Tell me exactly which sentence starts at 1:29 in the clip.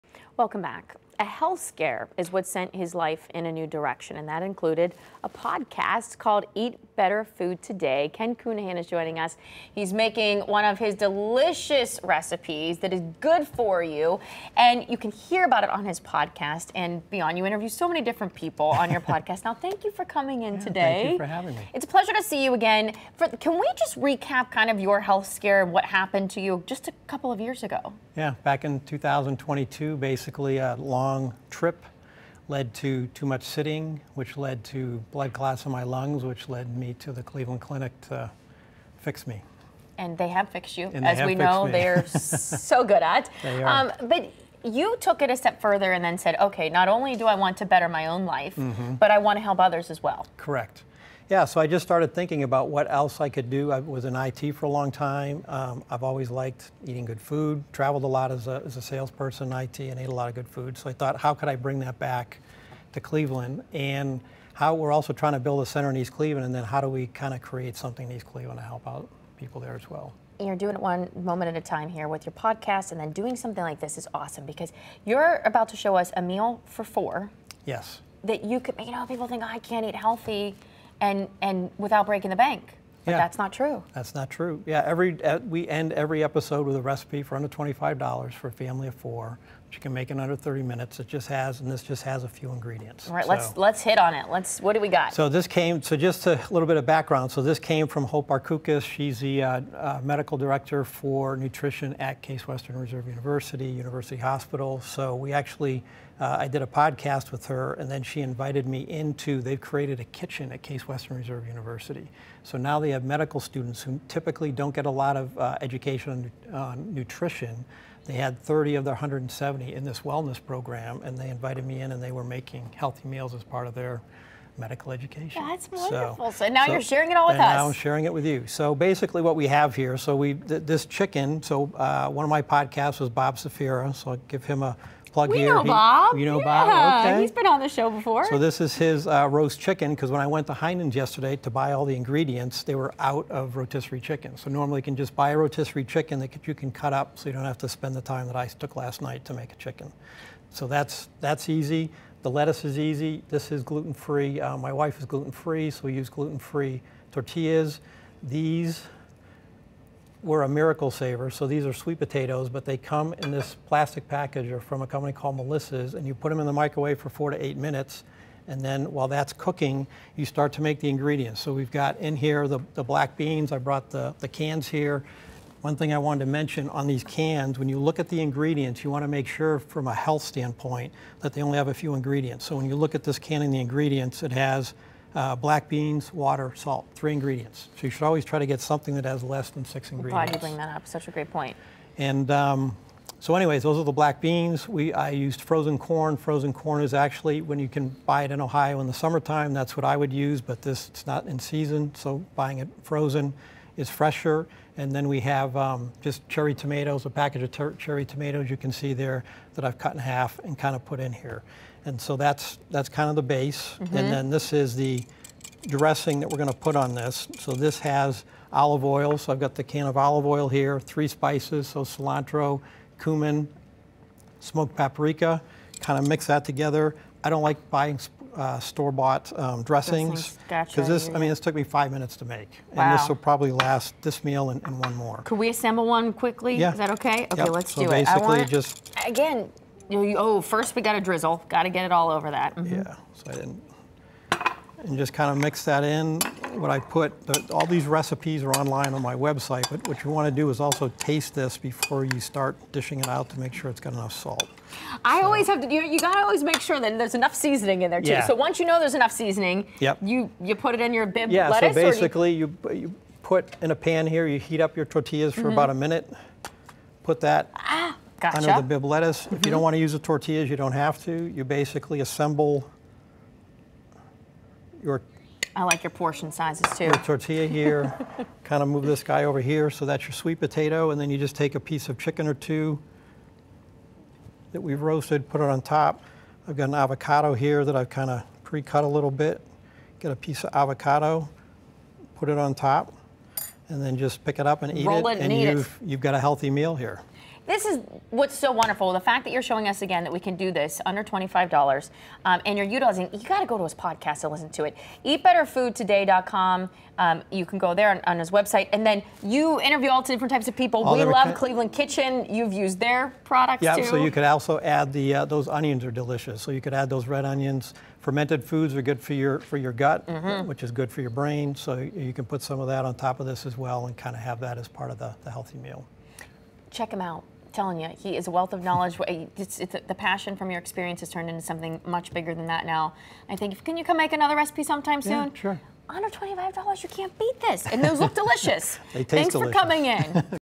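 which you can make in under thirty minutes.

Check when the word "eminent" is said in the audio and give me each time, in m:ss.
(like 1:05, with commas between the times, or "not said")
not said.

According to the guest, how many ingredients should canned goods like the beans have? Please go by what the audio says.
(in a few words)
fewer than 6.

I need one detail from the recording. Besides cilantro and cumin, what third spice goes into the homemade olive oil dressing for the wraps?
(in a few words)
smoked paprika.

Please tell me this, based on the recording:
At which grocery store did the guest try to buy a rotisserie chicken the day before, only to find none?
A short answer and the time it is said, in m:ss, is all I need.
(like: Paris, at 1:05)
Heinen's, at 2:20.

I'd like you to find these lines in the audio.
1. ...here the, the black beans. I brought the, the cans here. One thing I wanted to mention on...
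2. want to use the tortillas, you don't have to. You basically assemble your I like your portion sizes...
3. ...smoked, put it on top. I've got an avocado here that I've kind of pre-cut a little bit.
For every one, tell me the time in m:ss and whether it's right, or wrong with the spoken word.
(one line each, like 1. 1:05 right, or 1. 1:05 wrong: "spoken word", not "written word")
1. 2:52 right
2. 4:29 right
3. 4:44 wrong: "roasted", not "smoked".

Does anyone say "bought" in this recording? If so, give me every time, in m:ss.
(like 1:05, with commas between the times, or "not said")
3:48.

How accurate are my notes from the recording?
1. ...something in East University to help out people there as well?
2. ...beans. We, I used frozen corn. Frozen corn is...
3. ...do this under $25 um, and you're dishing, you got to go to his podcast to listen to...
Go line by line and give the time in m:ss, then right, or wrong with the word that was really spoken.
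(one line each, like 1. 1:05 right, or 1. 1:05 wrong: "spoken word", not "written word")
1. 1:07 wrong: "Cleveland", not "University"
2. 3:14 right
3. 5:00 wrong: "utilizing", not "dishing".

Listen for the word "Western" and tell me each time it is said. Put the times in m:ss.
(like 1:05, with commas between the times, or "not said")
1:42, 1:50.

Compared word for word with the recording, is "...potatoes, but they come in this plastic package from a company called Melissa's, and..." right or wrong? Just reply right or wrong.
right.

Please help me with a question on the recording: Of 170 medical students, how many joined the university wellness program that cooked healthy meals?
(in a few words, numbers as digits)
30.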